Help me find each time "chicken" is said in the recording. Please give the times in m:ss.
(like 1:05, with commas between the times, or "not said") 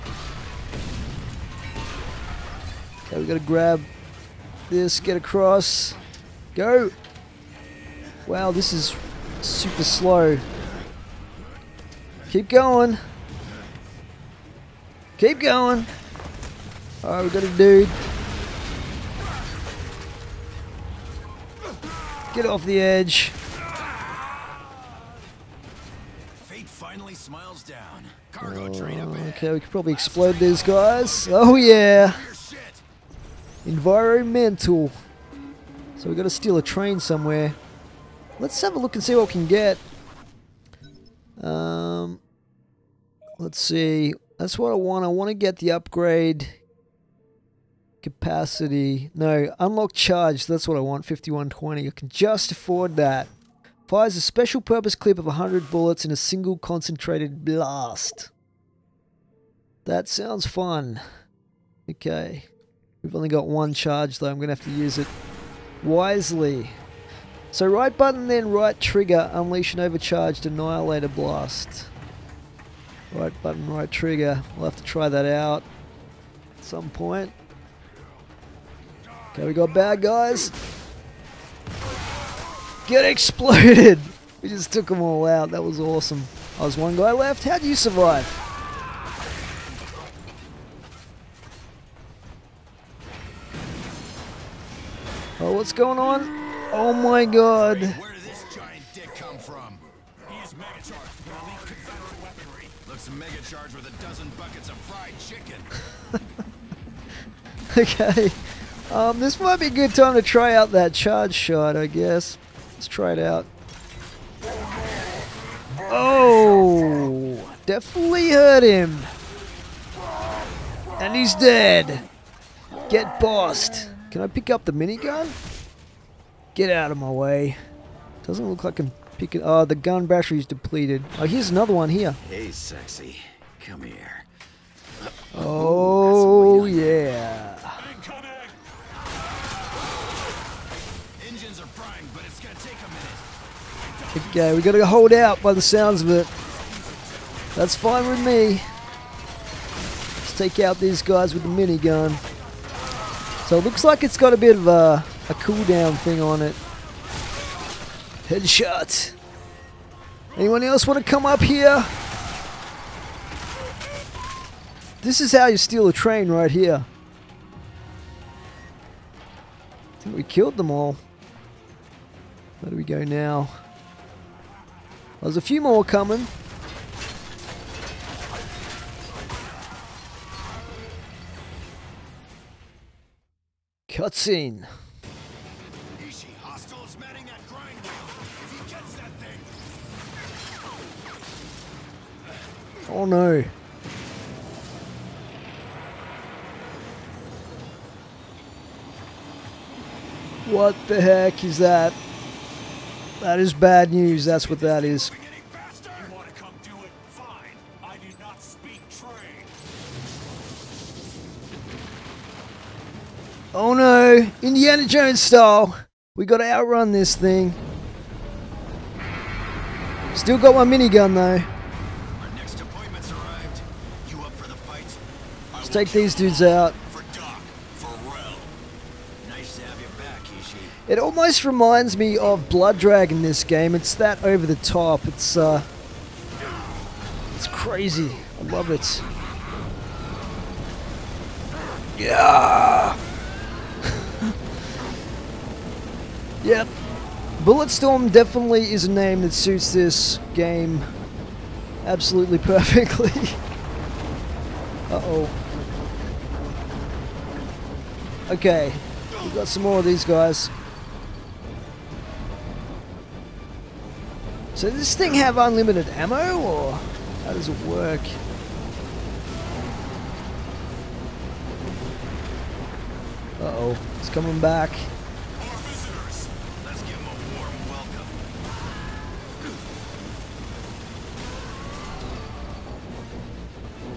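1:45.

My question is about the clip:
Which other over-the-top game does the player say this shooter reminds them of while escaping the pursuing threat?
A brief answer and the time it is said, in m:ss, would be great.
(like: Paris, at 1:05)
Blood Dragon, at 3:52.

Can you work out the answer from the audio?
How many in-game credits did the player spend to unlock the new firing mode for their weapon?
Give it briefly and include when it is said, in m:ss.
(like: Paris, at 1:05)
5120, at 0:51.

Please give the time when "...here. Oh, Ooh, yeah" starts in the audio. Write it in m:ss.
2:13.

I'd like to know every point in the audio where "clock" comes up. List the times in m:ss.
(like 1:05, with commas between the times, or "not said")
not said.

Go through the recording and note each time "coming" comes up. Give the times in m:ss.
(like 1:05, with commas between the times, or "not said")
2:55, 4:34.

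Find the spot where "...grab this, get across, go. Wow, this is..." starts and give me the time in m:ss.
0:03.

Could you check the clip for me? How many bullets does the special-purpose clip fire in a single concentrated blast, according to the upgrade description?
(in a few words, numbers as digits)
100.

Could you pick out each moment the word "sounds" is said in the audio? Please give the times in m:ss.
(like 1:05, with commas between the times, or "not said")
1:00, 2:25.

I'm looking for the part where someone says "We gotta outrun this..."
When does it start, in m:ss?
3:36.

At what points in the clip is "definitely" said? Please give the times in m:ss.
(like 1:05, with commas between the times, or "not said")
1:57, 4:08.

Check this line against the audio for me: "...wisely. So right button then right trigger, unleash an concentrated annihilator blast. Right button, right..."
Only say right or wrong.
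wrong.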